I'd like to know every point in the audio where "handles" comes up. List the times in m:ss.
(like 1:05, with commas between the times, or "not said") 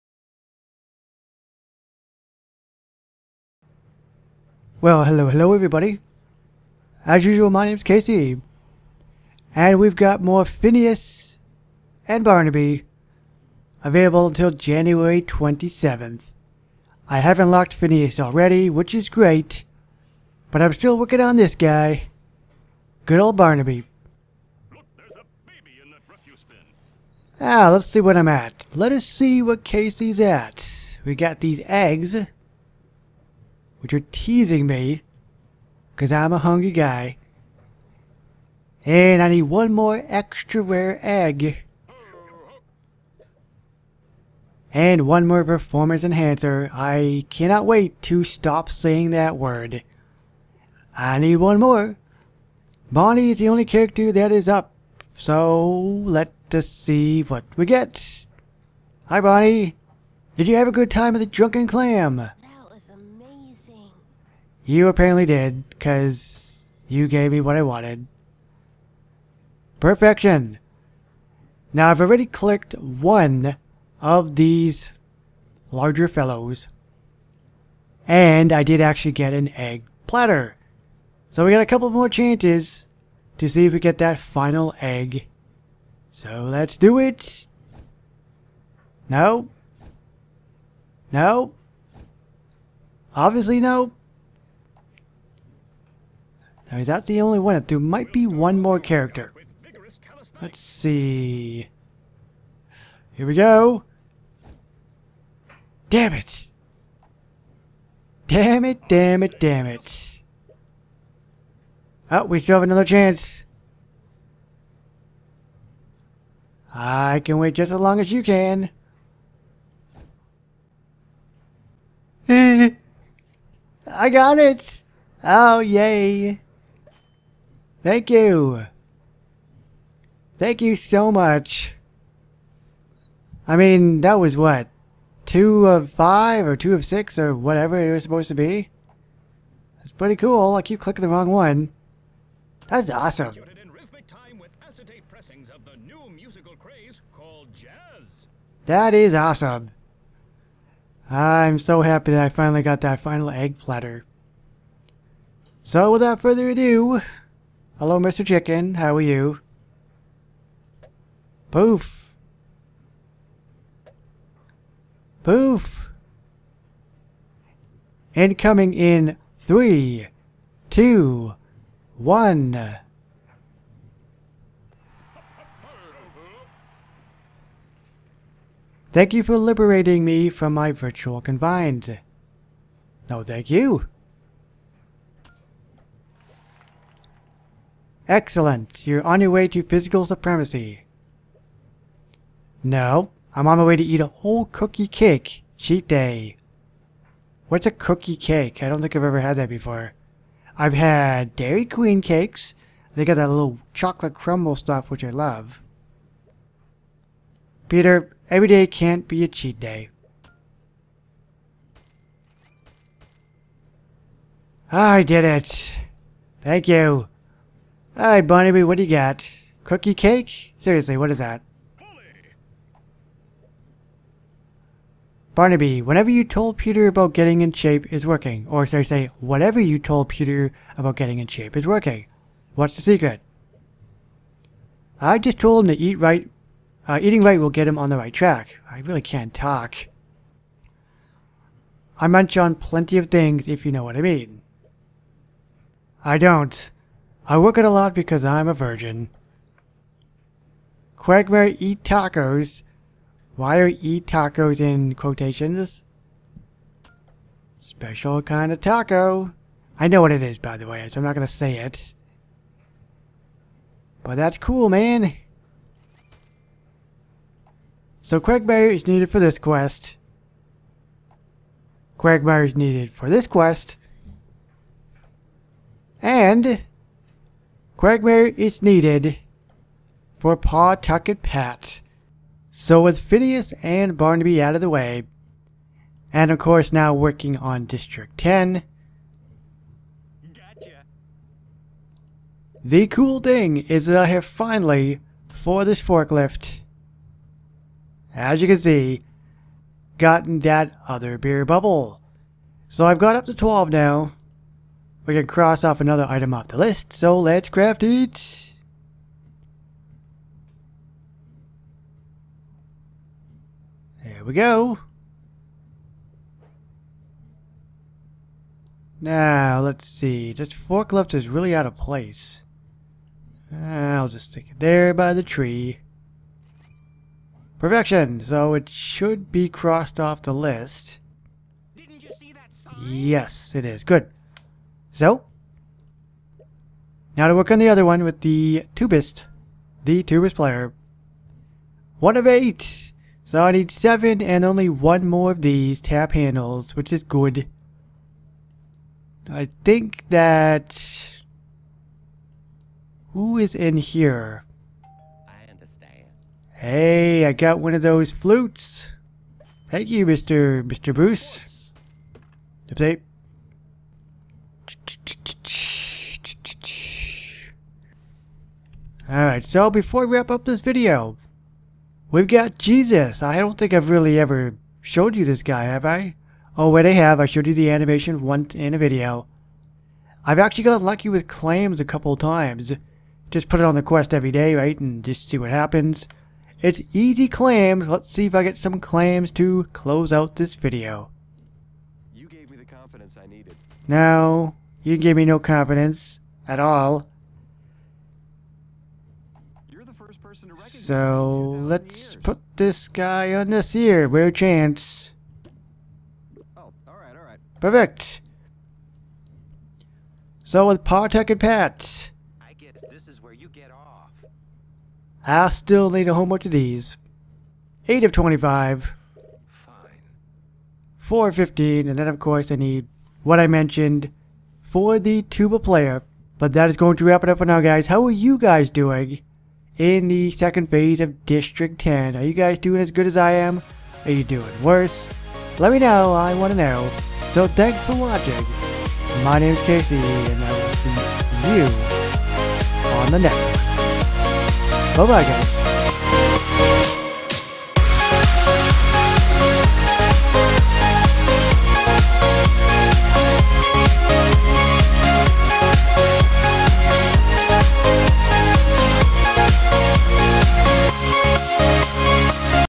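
5:46.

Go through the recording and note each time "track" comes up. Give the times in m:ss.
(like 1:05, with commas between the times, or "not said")
3:58.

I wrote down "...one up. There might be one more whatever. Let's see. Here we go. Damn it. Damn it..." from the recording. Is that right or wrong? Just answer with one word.
wrong.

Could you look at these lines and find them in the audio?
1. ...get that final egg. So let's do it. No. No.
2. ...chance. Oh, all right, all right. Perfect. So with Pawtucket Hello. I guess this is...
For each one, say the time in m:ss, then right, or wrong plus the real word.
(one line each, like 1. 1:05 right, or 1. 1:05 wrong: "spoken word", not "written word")
1. 1:23 right
2. 6:44 wrong: "Pat", not "Hello".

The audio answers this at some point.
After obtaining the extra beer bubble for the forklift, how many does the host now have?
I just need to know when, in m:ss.
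5:03.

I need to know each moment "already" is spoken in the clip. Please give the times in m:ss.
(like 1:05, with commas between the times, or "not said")
0:18, 1:12.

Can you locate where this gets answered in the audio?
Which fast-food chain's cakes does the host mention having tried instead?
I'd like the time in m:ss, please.
3:21.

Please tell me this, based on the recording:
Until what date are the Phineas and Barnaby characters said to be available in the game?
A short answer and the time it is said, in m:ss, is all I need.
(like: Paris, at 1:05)
January 27th, at 0:14.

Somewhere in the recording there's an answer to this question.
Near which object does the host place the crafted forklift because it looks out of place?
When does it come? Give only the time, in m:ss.
5:24.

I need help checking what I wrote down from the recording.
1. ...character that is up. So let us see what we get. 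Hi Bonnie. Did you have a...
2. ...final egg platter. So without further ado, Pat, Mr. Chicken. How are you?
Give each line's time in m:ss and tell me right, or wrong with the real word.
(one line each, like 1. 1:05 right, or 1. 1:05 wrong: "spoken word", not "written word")
1. 0:53 right
2. 2:32 wrong: "Hello", not "Pat".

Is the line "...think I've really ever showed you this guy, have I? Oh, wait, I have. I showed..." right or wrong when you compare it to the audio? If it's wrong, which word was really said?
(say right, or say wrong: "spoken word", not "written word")
right.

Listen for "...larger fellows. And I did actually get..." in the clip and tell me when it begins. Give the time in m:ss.
1:15.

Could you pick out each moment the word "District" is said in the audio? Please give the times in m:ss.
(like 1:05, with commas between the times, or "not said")
4:47, 7:11.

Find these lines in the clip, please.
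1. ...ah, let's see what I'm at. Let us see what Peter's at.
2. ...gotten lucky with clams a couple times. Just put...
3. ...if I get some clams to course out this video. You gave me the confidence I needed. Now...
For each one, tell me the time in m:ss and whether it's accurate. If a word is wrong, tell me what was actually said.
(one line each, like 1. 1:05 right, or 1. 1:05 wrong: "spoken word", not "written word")
1. 0:27 wrong: "Casey", not "Peter"
2. 6:20 right
3. 6:28 wrong: "close", not "course".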